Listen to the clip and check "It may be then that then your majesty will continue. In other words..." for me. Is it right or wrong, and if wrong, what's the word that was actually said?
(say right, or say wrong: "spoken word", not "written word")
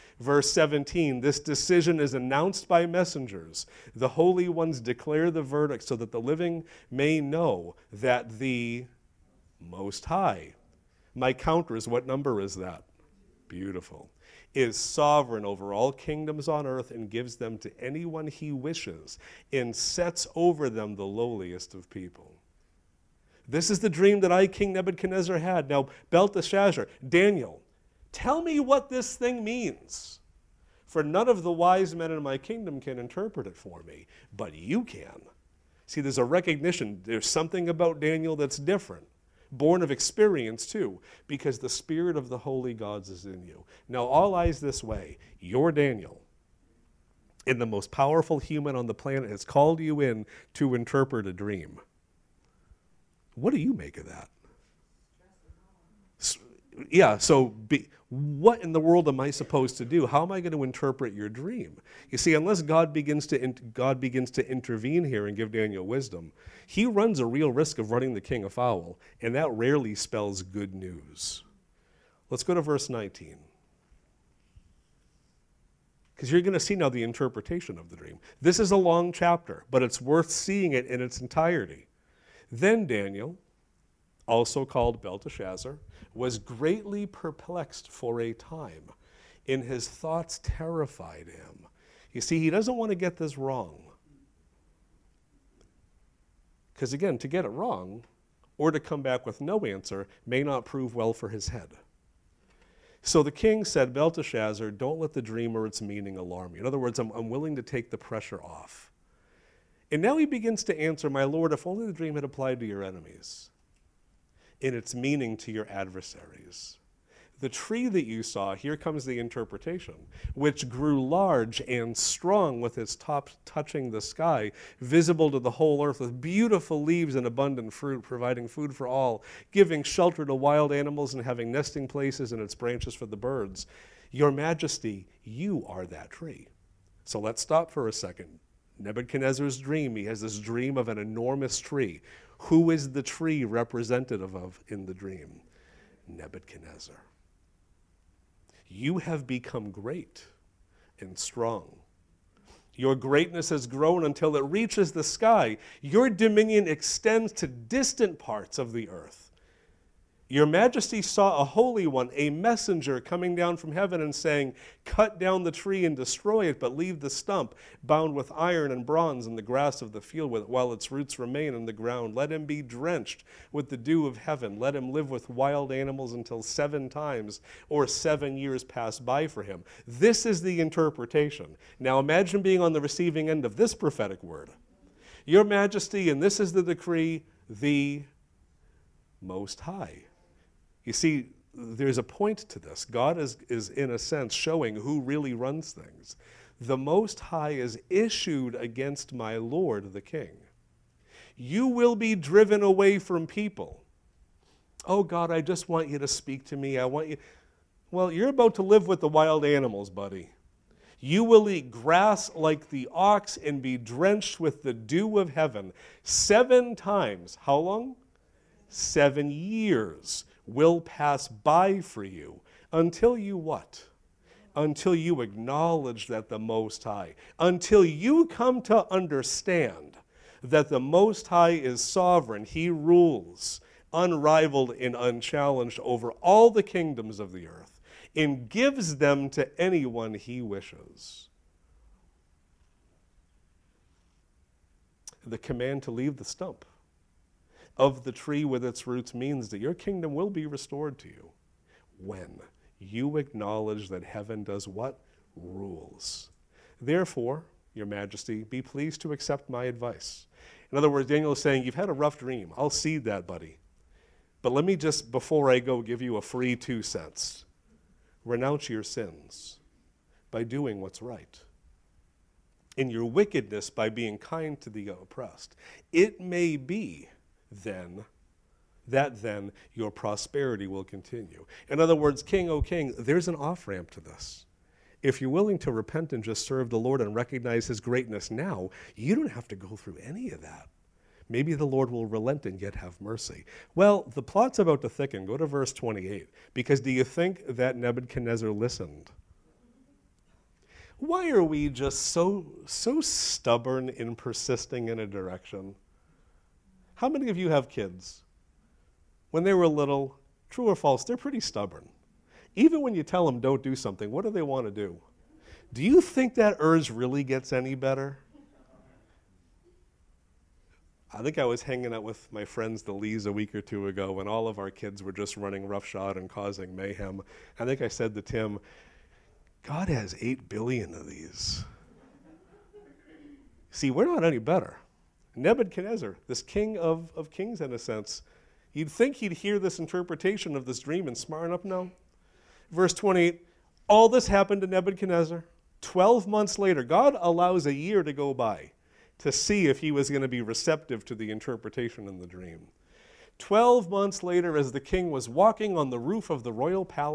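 wrong: "prosperity", not "majesty".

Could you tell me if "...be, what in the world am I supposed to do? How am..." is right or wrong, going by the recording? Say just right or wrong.
right.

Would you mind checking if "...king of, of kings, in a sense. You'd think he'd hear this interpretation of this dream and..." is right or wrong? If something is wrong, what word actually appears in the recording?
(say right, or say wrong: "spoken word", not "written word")
right.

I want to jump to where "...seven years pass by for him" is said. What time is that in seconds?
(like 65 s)
177 s.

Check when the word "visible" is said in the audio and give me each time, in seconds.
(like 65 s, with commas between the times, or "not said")
124 s.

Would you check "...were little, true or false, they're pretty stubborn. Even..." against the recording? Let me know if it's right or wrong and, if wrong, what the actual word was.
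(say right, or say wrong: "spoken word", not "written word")
right.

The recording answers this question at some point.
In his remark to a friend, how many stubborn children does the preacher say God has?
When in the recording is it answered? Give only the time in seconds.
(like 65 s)
330 s.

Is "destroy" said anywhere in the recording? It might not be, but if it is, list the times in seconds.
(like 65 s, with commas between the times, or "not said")
165 s.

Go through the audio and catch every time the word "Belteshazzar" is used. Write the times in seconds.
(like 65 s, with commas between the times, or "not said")
26 s, 85 s, 103 s.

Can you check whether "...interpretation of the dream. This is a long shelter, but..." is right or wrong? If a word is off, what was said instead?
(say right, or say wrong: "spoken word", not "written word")
wrong: "chapter", not "shelter".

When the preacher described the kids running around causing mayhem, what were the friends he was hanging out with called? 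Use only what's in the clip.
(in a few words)
the Lees.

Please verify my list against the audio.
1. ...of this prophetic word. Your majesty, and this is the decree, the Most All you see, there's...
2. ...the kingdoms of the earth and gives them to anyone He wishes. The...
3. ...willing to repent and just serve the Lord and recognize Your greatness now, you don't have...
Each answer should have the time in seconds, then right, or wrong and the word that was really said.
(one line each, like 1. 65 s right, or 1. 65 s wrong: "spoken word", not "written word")
1. 183 s wrong: "High", not "All"
2. 236 s right
3. 285 s wrong: "His", not "Your".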